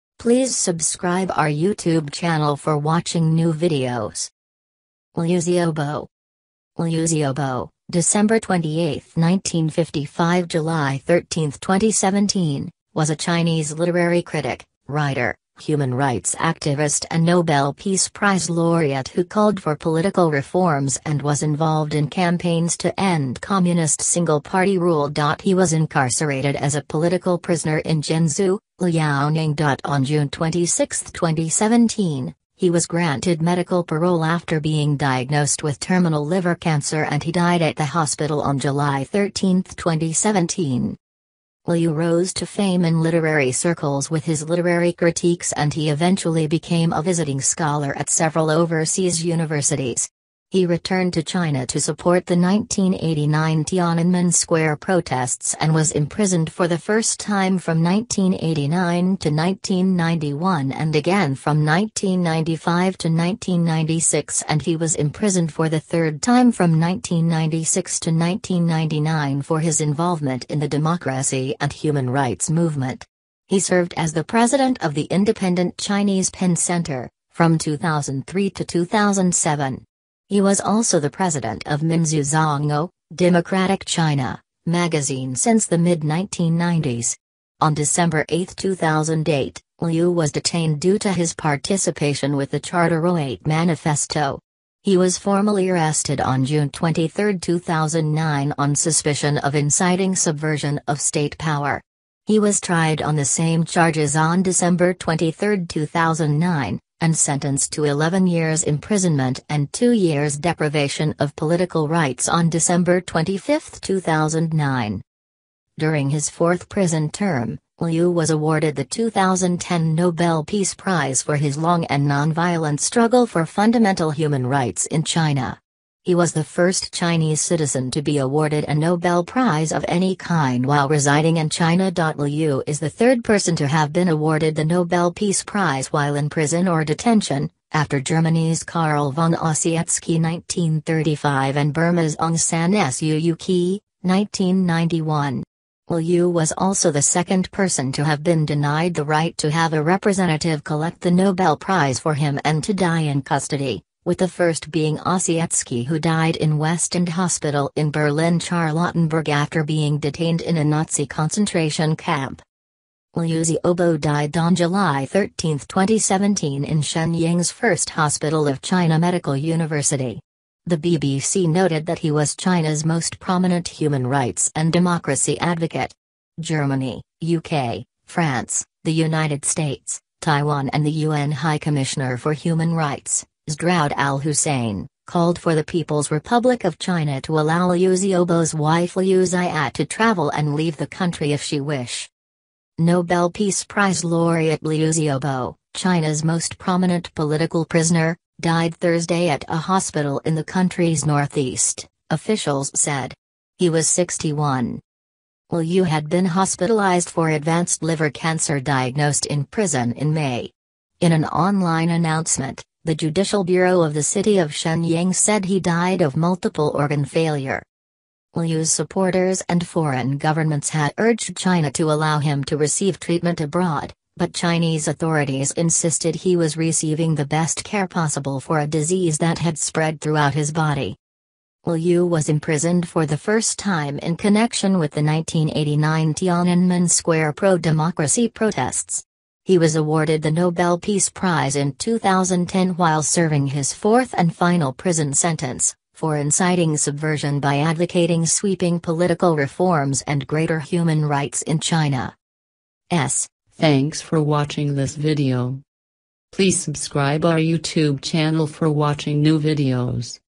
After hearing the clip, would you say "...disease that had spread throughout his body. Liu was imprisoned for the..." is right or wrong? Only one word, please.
right.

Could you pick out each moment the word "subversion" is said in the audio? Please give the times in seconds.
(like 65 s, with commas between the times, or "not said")
100 s, 246 s.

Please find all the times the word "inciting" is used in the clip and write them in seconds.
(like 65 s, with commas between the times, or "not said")
99 s, 246 s.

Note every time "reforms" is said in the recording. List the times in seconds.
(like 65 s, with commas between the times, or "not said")
20 s, 249 s.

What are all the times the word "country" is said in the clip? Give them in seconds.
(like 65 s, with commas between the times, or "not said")
190 s, 200 s.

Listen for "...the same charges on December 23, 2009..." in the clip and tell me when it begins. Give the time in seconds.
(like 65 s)
103 s.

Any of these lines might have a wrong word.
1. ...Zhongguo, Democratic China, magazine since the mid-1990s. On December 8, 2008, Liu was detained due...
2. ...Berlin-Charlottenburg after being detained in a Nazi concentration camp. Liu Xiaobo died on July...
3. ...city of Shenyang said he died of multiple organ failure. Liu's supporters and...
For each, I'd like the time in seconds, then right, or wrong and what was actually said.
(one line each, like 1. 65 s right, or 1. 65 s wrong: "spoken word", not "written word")
1. 82 s right
2. 157 s right
3. 214 s right.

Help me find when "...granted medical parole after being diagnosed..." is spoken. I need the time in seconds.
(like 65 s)
32 s.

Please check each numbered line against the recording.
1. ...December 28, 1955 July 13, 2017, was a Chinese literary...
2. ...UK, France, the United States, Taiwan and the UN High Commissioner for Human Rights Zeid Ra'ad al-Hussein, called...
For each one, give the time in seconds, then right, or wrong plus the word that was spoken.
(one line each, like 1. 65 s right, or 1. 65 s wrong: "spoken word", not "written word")
1. 7 s right
2. 177 s right.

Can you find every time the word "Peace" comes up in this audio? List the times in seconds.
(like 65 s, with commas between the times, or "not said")
17 s, 120 s, 135 s, 193 s, 240 s.